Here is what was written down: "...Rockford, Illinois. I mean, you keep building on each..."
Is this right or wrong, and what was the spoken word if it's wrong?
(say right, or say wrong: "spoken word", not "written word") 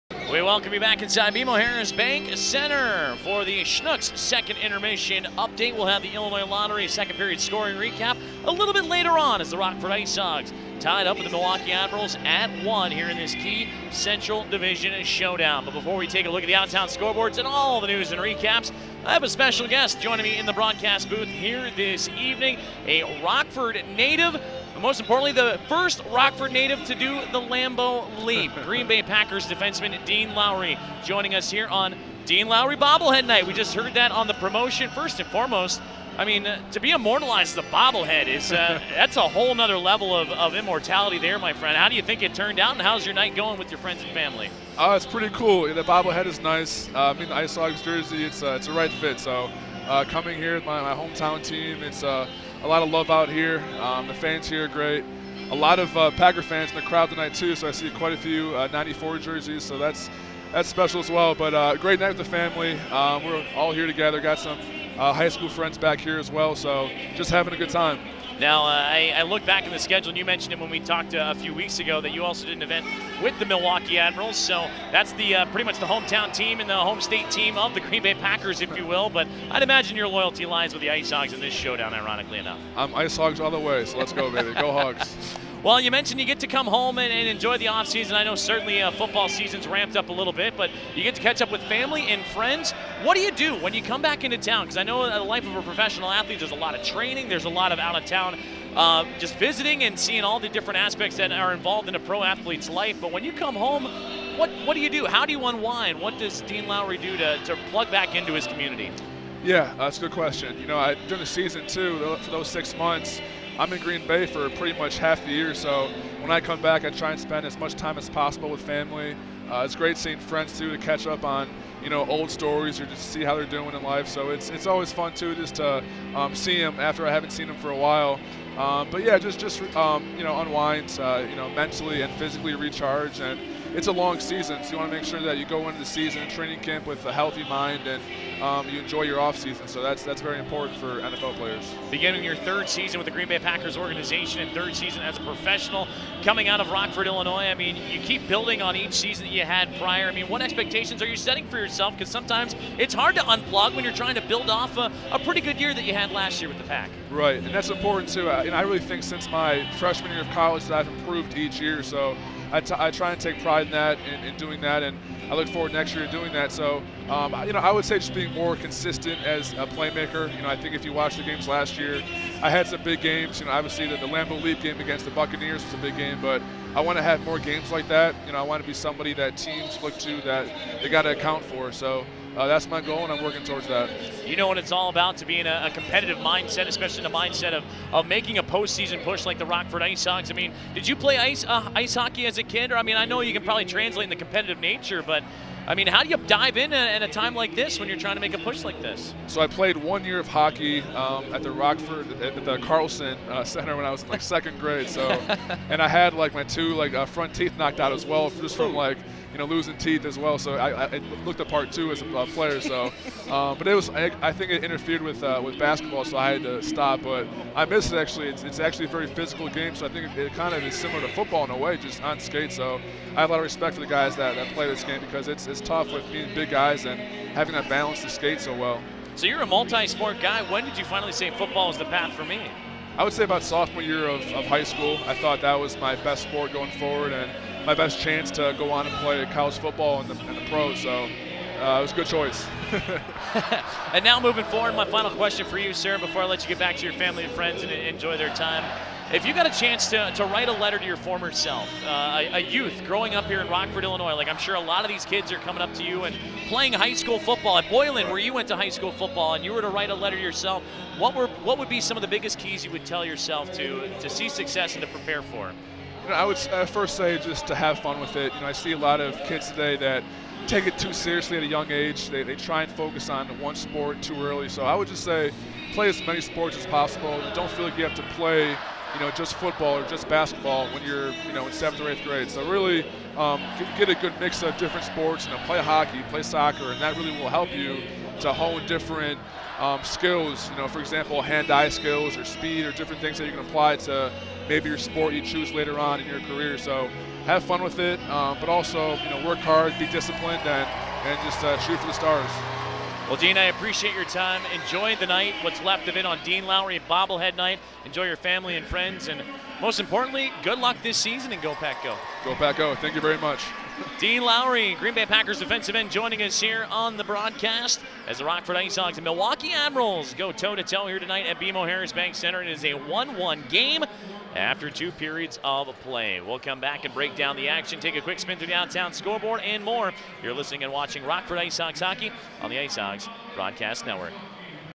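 right.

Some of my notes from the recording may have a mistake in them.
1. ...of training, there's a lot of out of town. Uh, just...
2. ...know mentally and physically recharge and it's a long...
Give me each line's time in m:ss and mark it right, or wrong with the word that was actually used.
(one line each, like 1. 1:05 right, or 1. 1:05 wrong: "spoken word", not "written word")
1. 1:36 right
2. 2:11 right.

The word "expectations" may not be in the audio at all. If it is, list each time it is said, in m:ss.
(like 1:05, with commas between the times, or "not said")
2:30.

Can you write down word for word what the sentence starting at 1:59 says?
Uh, it's great seeing friends too to catch up on you know old stories or just see how they're doing in life.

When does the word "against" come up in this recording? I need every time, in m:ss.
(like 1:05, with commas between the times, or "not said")
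2:54.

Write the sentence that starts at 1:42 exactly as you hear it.
But when you come home, what, what do you do?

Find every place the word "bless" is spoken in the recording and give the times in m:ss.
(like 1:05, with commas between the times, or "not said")
not said.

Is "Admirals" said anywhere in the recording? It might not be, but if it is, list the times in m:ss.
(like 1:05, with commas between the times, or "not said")
0:11, 1:13, 5:19.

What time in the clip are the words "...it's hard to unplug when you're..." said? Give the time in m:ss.
2:32.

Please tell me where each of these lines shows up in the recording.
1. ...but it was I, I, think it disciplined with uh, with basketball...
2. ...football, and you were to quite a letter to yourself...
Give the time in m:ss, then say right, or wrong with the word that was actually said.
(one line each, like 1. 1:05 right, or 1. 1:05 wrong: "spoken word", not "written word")
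1. 3:33 wrong: "interfered", not "disciplined"
2. 4:18 wrong: "write", not "quite".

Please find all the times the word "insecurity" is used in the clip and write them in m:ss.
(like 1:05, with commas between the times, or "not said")
not said.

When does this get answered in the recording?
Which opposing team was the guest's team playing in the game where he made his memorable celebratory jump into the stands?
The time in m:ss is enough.
2:55.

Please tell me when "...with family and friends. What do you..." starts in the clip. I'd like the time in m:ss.
1:31.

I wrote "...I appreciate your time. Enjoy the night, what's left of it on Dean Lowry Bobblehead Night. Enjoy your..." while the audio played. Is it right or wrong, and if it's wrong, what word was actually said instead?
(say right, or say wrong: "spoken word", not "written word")
right.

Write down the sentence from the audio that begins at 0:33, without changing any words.
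We just heard that on the promotion.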